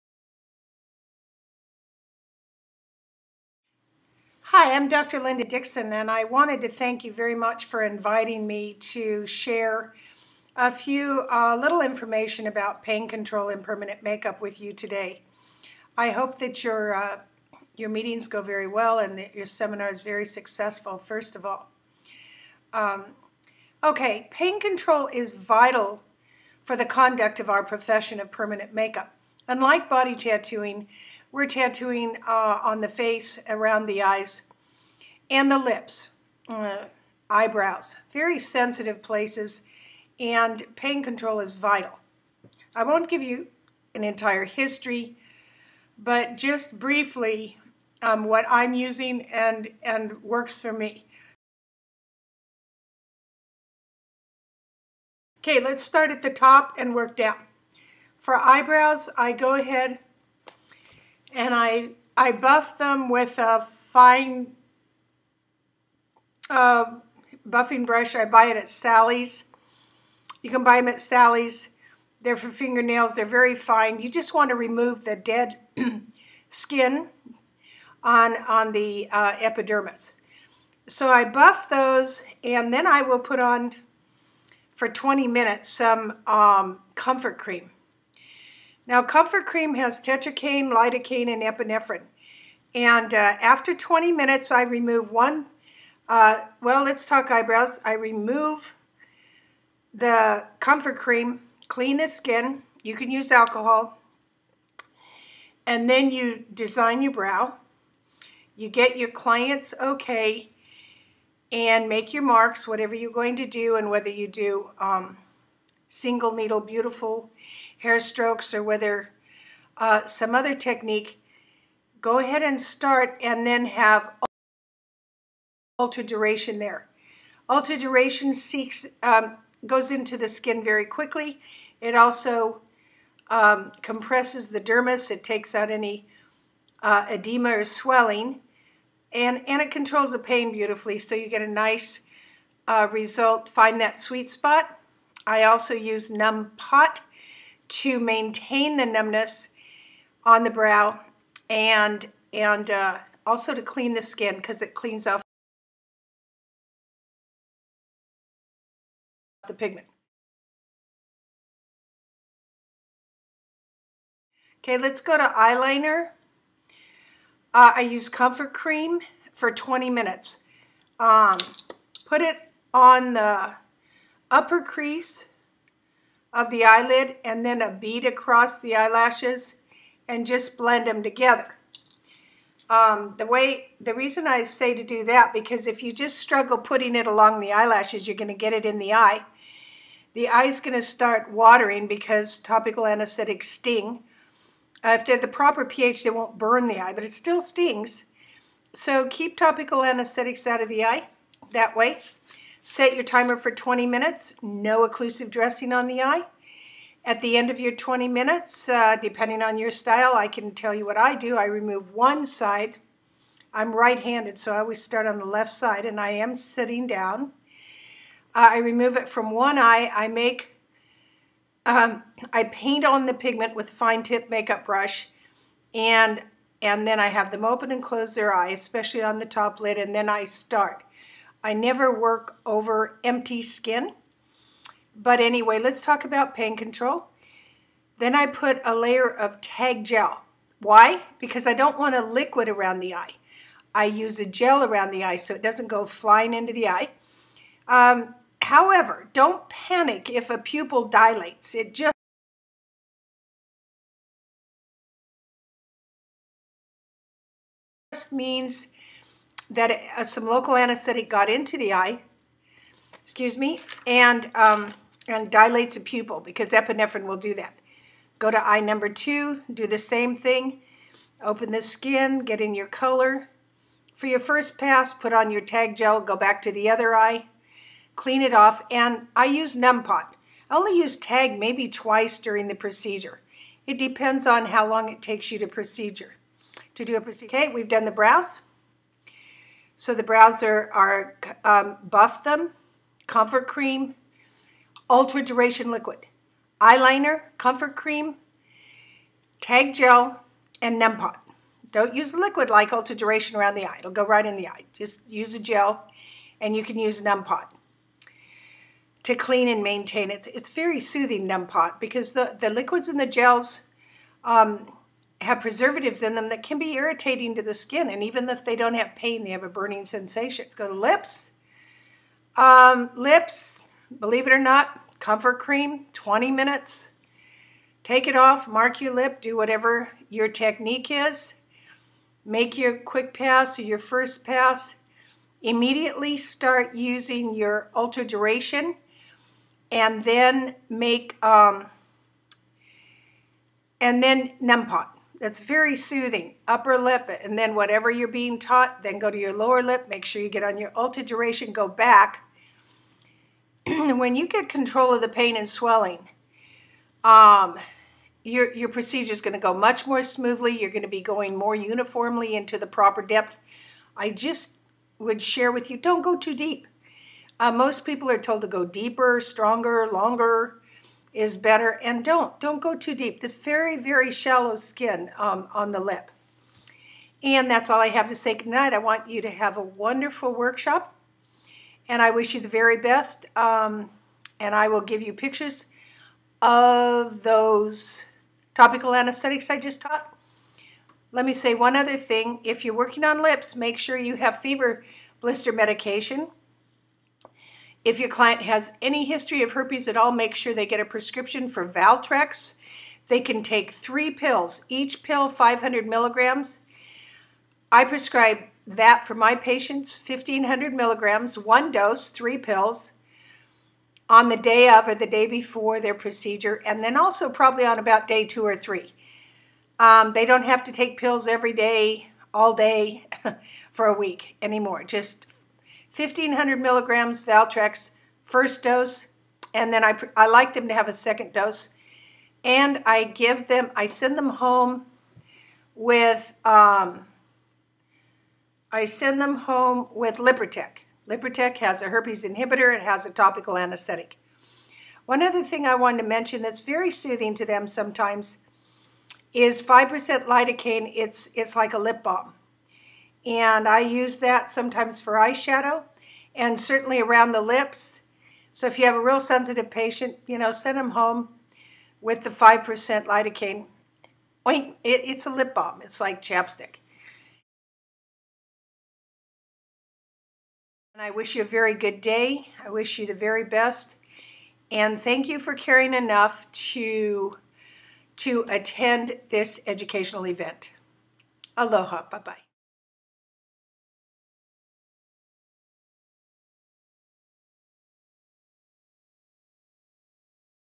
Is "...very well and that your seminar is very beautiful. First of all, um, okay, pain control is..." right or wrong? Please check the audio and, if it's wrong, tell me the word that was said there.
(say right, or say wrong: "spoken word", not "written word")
wrong: "successful", not "beautiful".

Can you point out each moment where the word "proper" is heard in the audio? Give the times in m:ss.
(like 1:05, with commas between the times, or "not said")
3:15, 6:02.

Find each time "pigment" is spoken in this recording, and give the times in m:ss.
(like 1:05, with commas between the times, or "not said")
2:39, 3:43.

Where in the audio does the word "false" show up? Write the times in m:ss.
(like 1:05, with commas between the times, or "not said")
not said.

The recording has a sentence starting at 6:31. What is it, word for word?
Let me say one other thing.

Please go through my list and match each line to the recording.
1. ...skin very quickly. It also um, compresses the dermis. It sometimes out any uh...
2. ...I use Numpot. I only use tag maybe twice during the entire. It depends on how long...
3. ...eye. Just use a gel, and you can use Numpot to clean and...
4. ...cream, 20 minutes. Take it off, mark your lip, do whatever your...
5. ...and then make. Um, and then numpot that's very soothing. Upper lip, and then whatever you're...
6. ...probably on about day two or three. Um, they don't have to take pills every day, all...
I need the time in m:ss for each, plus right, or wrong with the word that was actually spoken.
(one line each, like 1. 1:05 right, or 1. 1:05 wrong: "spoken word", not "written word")
1. 2:10 wrong: "takes", not "sometimes"
2. 4:39 wrong: "procedure", not "entire"
3. 5:04 right
4. 5:25 right
5. 5:39 right
6. 6:57 right.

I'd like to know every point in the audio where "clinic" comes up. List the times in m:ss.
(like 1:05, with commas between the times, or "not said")
not said.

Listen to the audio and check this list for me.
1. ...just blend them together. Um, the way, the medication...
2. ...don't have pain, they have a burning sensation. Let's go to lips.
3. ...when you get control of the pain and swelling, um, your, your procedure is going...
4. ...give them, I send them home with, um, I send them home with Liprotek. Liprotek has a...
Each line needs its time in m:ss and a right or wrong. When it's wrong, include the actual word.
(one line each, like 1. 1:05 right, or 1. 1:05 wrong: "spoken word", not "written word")
1. 3:00 wrong: "reason", not "medication"
2. 5:18 right
3. 5:53 right
4. 7:13 right.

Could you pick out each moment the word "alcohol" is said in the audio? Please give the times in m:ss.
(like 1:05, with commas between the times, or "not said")
1:43.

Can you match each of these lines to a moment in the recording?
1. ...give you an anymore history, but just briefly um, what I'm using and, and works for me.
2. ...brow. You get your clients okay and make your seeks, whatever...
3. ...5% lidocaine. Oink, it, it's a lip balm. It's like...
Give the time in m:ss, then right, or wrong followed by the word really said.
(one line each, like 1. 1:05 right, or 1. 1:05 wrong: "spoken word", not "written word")
1. 0:43 wrong: "entire", not "anymore"
2. 1:47 wrong: "marks", not "seeks"
3. 7:42 right.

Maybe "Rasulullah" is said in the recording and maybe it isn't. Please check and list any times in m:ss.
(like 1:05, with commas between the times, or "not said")
not said.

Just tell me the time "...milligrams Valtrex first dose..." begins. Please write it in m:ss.
7:06.